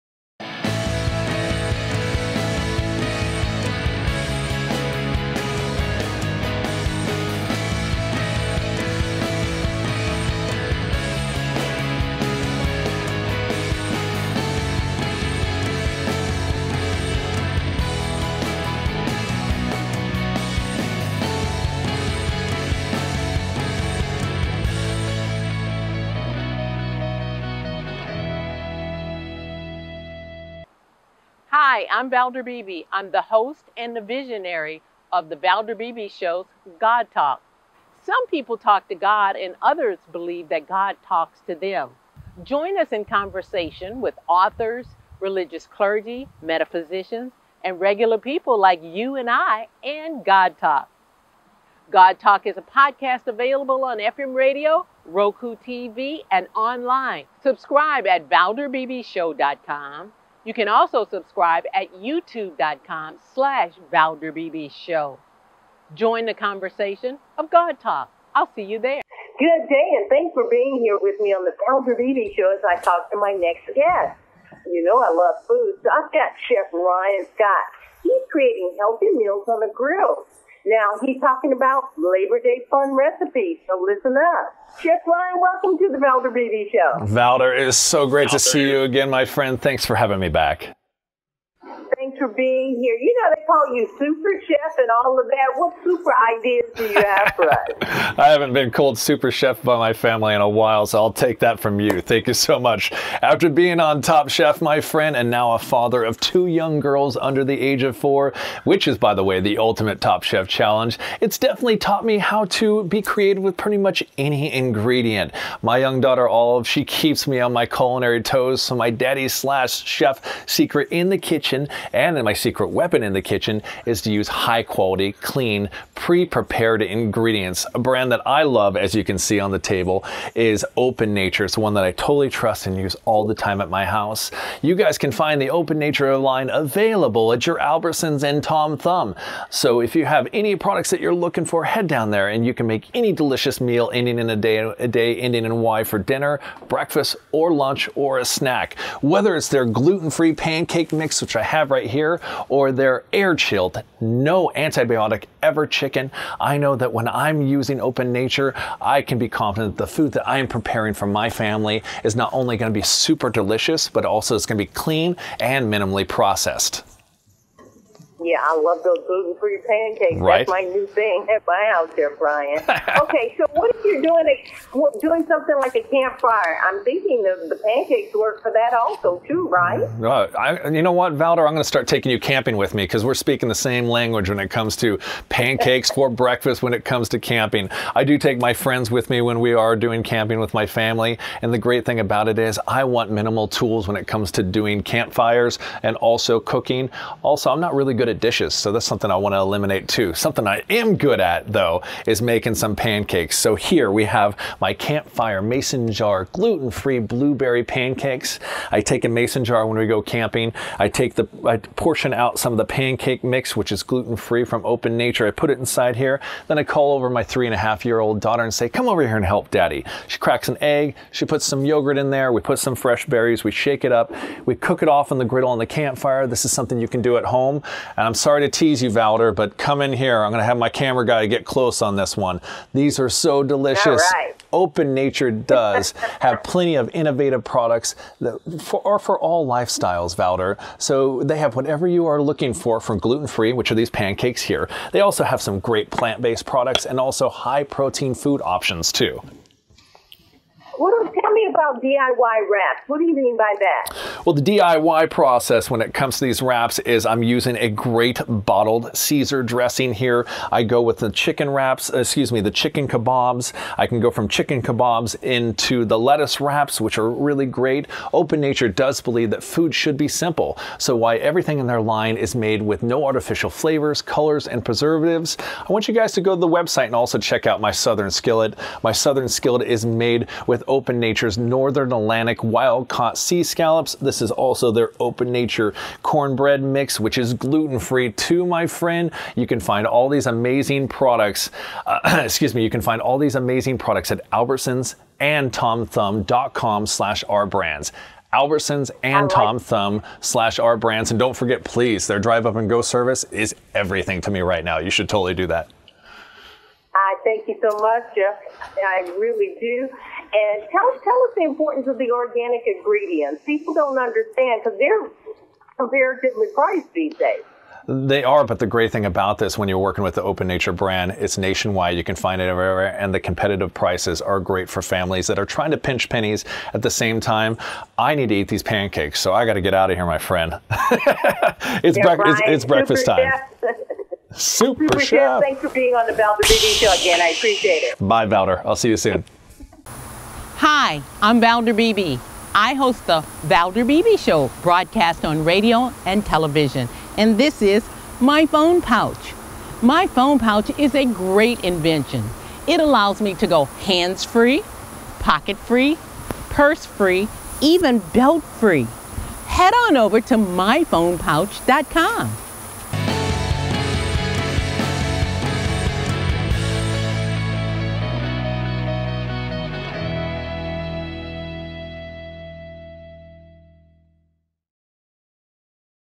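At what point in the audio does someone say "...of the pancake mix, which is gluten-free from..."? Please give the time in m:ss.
3:32.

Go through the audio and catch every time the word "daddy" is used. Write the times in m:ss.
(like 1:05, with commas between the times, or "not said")
1:58, 3:39.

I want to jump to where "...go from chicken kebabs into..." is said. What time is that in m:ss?
4:23.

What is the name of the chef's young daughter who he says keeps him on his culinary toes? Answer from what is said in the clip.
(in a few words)
Olive.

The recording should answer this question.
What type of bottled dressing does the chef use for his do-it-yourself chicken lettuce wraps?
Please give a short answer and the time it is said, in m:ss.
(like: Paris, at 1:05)
Caesar, at 4:18.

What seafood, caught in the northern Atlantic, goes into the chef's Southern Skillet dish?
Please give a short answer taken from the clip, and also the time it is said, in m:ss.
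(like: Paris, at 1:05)
sea scallops, at 4:43.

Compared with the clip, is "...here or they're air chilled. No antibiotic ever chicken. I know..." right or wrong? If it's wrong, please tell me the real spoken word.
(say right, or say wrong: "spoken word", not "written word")
right.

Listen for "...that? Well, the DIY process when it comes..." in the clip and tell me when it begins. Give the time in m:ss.
4:13.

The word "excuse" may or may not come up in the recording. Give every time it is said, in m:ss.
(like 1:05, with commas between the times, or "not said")
4:21, 4:52.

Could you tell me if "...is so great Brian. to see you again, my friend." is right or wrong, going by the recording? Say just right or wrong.
wrong.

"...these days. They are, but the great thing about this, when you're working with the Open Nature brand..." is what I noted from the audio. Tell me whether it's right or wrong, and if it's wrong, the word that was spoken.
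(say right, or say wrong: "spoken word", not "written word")
right.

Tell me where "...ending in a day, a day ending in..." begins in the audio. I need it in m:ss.
2:23.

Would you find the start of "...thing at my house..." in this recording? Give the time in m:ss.
2:50.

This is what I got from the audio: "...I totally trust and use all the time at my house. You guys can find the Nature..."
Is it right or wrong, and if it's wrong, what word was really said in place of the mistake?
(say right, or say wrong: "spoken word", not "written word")
wrong: "Open", not "Nature".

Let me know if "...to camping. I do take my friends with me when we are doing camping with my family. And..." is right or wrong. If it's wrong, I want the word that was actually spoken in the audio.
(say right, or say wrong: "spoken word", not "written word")
right.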